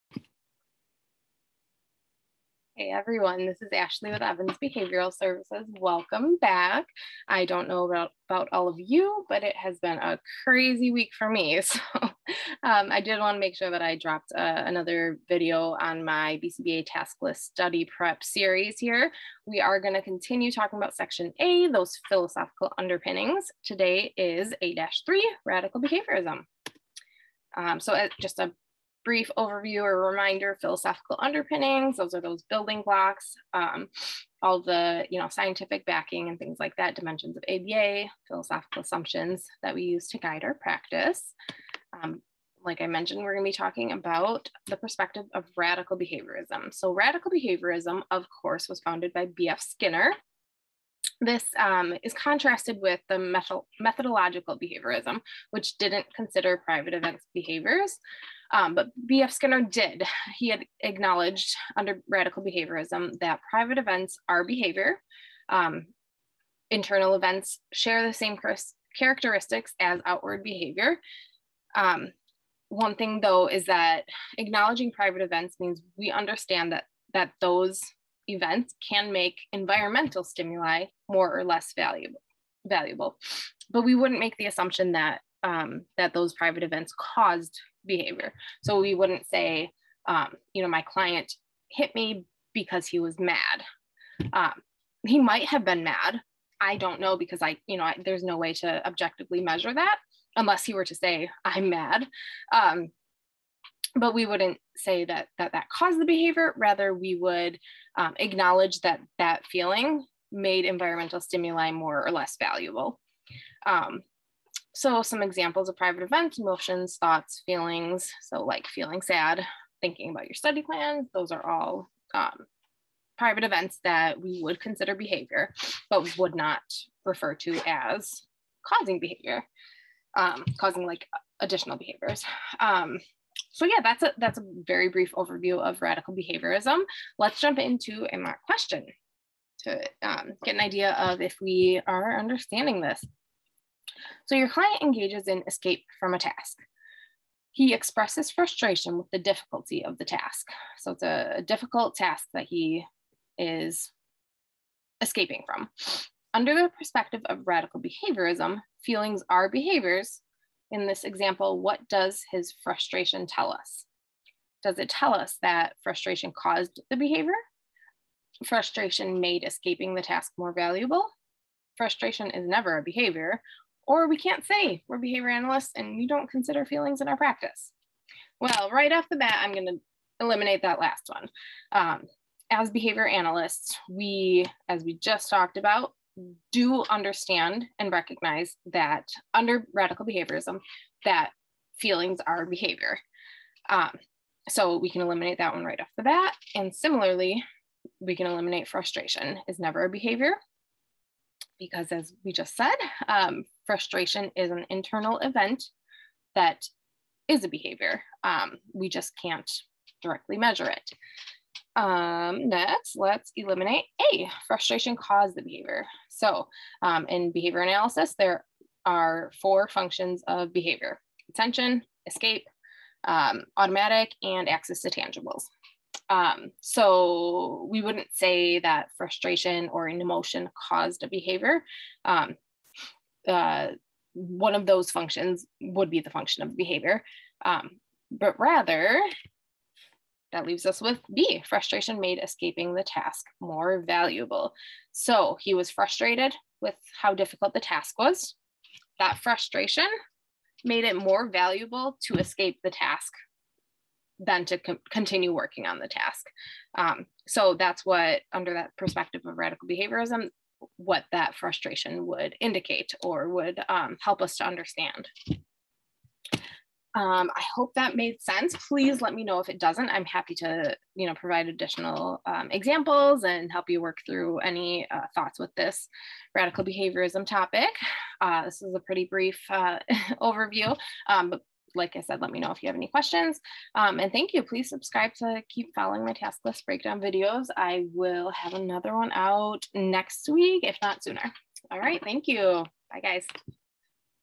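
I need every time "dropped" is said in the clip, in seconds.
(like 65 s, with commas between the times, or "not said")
13 s.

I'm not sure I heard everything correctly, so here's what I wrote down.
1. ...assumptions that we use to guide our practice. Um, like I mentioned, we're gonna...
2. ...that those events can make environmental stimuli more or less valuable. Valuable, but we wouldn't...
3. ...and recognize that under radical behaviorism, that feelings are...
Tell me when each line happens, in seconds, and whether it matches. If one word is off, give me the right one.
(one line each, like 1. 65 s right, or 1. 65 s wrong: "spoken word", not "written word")
1. 38 s right
2. 77 s right
3. 187 s right.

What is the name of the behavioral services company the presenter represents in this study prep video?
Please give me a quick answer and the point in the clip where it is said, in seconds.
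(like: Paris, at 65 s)
Evans Behavioral Services, at 4 s.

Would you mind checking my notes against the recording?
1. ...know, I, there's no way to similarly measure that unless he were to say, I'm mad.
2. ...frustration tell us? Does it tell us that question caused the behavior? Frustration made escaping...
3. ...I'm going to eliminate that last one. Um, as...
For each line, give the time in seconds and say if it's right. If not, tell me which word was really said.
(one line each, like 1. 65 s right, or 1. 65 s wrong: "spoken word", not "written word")
1. 97 s wrong: "objectively", not "similarly"
2. 162 s wrong: "frustration", not "question"
3. 179 s right.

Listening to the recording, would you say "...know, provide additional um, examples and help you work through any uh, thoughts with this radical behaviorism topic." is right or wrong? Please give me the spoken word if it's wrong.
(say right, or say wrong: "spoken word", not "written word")
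right.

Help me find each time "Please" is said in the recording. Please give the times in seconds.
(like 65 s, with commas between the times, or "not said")
268 s, 284 s.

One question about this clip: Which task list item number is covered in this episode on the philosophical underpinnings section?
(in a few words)
A-3.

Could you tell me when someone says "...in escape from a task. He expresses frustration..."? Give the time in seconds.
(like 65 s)
145 s.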